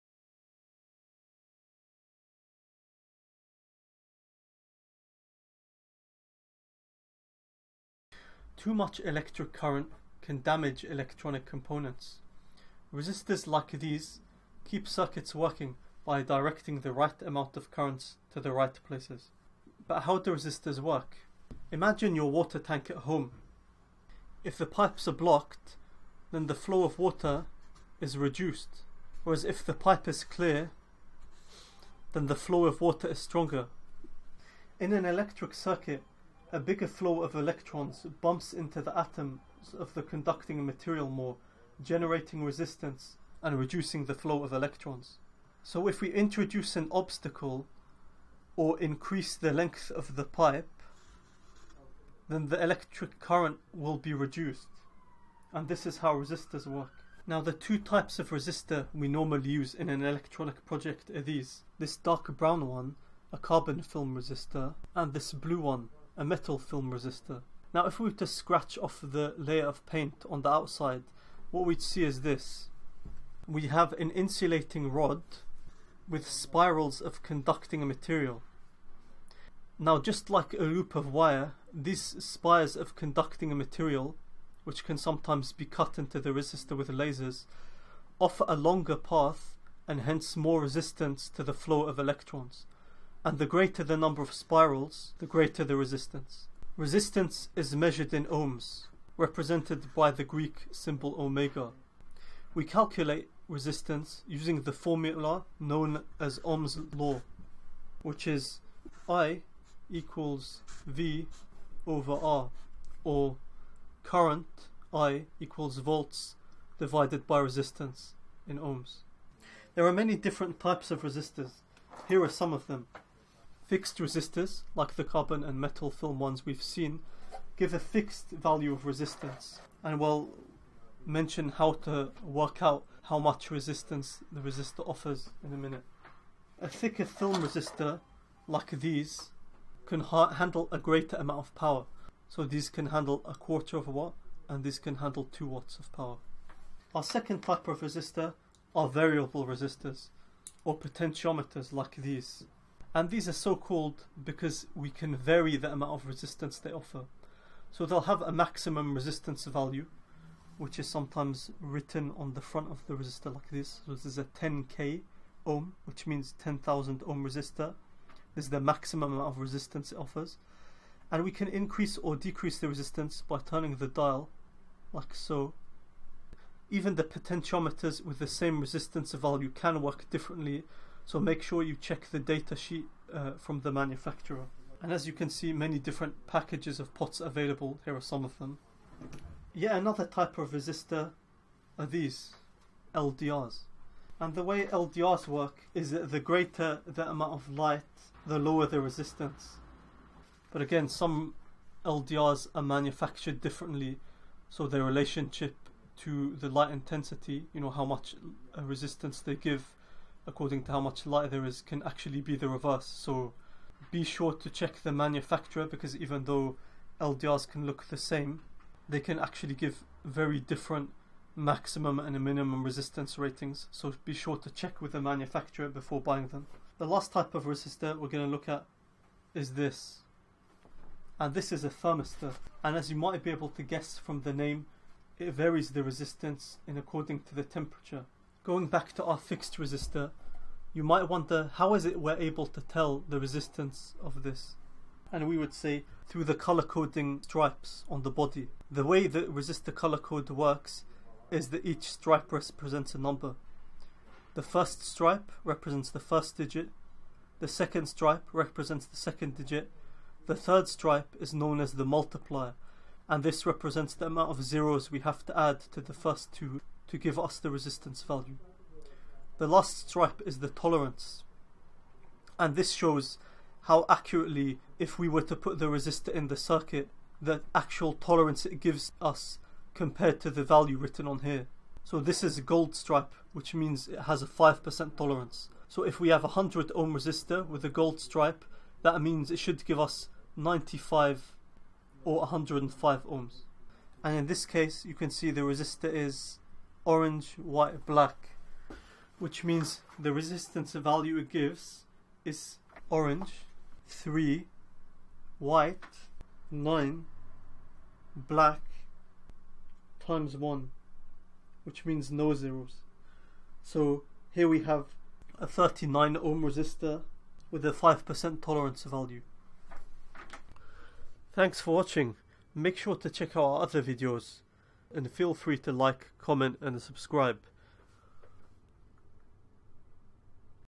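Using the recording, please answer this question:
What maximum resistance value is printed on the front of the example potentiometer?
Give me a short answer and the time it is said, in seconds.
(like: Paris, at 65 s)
10k ohm, at 164 s.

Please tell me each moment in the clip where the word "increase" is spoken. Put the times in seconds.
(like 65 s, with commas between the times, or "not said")
48 s, 171 s.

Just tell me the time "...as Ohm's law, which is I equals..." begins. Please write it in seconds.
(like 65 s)
106 s.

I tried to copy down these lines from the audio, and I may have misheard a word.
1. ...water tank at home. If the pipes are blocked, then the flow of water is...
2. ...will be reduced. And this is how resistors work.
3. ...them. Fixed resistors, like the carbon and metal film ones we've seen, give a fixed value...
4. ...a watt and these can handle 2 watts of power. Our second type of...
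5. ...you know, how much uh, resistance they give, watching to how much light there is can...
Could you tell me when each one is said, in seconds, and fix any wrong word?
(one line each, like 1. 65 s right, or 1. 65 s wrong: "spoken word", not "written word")
1. 22 s right
2. 53 s right
3. 122 s right
4. 143 s right
5. 207 s wrong: "according", not "watching".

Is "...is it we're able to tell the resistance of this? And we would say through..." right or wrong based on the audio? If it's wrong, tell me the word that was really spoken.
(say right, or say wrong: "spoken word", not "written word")
right.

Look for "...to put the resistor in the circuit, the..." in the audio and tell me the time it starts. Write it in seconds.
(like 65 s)
275 s.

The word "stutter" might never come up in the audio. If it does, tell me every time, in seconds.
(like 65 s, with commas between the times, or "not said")
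not said.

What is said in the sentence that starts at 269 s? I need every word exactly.
The last stripe is the tolerance.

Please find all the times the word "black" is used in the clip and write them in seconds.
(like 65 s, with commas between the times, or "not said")
297 s, 308 s.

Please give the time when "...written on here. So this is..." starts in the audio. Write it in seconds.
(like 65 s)
280 s.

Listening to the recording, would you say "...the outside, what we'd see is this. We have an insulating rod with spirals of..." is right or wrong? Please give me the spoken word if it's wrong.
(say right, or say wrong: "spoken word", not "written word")
right.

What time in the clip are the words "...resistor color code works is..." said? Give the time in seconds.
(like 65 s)
249 s.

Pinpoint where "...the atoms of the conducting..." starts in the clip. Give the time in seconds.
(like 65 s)
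38 s.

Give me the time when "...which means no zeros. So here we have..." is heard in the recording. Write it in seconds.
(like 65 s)
311 s.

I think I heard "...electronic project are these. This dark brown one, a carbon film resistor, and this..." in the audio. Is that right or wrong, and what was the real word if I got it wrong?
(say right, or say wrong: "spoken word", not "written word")
right.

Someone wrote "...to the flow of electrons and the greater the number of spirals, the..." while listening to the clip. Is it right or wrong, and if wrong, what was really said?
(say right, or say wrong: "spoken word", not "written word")
right.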